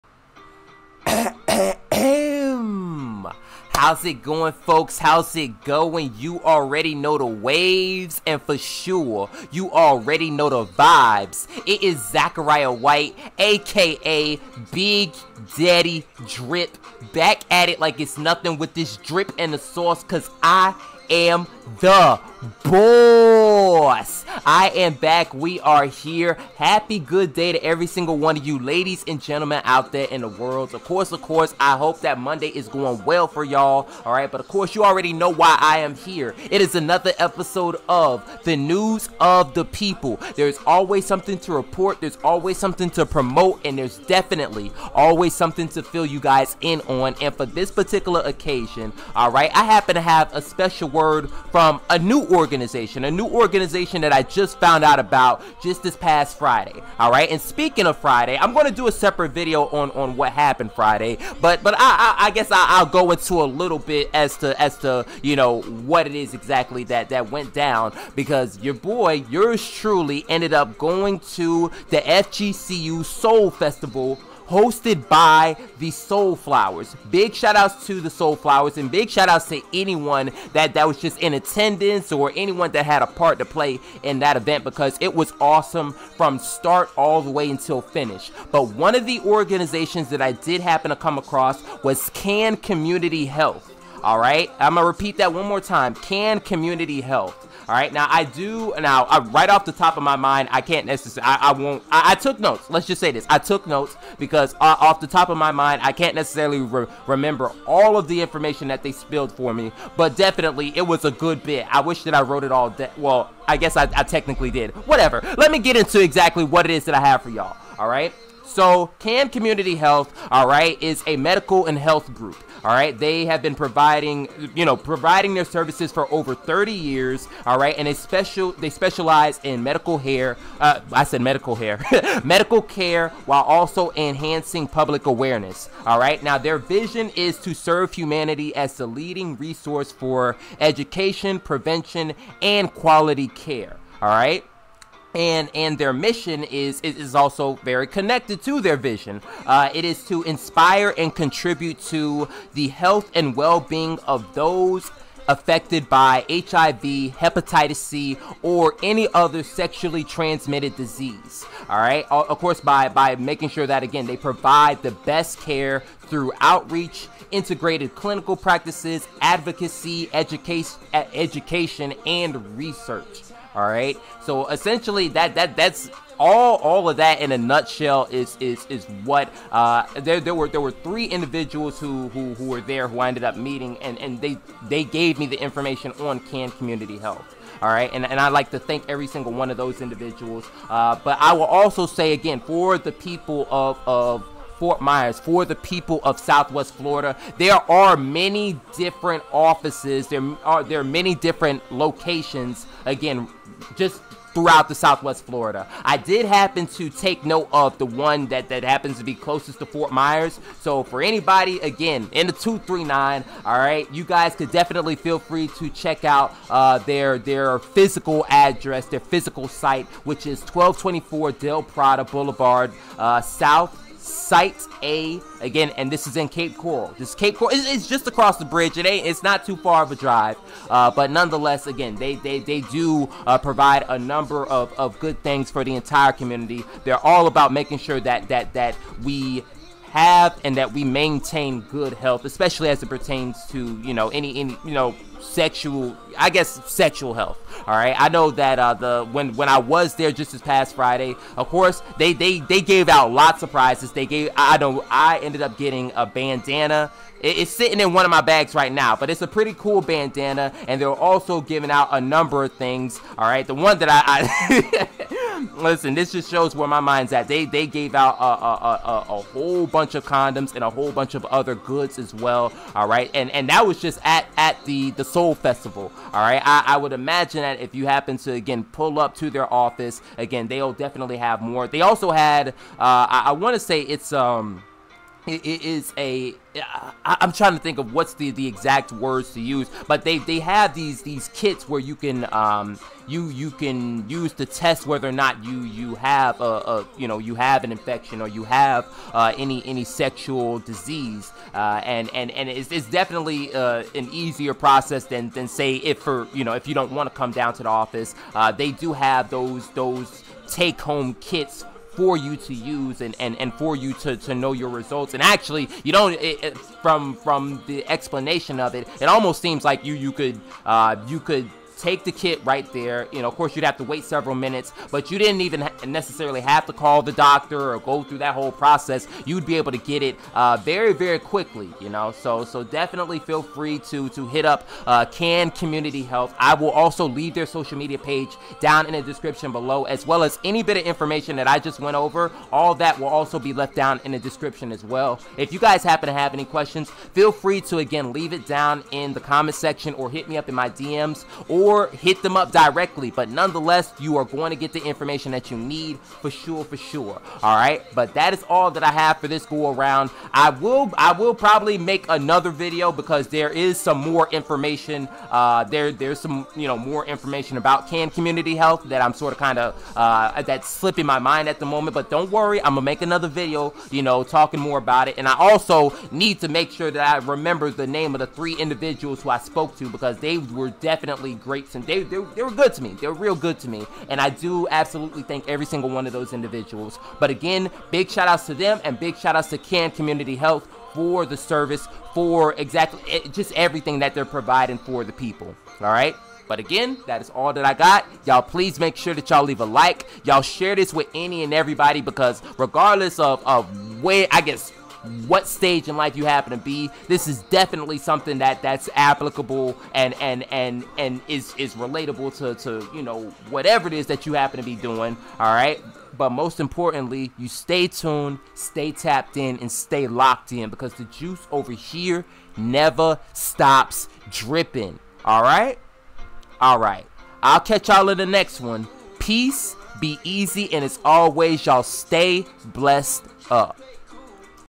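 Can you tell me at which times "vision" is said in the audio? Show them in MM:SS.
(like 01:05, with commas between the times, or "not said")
02:16, 02:28.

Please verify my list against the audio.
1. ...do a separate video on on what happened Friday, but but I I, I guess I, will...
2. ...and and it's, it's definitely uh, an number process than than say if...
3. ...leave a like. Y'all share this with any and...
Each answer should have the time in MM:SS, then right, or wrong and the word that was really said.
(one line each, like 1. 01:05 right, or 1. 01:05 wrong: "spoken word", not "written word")
1. 00:58 right
2. 05:02 wrong: "easier", not "number"
3. 06:39 right.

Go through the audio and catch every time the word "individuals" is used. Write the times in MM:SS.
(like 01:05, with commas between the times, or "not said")
03:01, 03:09, 06:18, 06:26.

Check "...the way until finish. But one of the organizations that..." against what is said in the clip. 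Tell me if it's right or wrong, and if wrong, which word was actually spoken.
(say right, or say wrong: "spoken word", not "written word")
right.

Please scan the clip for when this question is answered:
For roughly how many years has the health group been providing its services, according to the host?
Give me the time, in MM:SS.
02:06.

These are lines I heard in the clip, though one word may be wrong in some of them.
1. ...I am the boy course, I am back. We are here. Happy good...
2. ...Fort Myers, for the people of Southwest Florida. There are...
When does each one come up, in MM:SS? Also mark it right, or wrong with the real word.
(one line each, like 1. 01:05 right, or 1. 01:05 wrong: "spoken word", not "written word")
1. 00:20 right
2. 03:14 right.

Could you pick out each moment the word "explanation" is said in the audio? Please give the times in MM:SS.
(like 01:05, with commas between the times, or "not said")
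05:17.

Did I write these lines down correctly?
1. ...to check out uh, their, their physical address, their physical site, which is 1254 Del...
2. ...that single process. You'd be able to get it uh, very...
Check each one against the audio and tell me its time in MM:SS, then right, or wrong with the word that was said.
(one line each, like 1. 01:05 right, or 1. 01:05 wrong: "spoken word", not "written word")
1. 03:35 wrong: "1224", not "1254"
2. 05:28 wrong: "whole", not "single".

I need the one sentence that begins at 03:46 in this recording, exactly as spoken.
This Cape Coral it's, it's, just across the bridge.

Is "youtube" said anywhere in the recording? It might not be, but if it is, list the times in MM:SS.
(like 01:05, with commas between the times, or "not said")
not said.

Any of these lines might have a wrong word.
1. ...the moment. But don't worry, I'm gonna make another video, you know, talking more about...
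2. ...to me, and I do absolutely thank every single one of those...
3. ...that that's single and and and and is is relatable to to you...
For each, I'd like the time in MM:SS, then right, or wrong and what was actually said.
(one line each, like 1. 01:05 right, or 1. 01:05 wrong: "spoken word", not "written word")
1. 06:11 right
2. 06:23 right
3. 06:48 wrong: "applicable", not "single".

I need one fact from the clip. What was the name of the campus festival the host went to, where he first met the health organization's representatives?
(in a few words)
FGCU Soul Festival.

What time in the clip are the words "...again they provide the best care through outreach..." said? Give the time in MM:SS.
02:43.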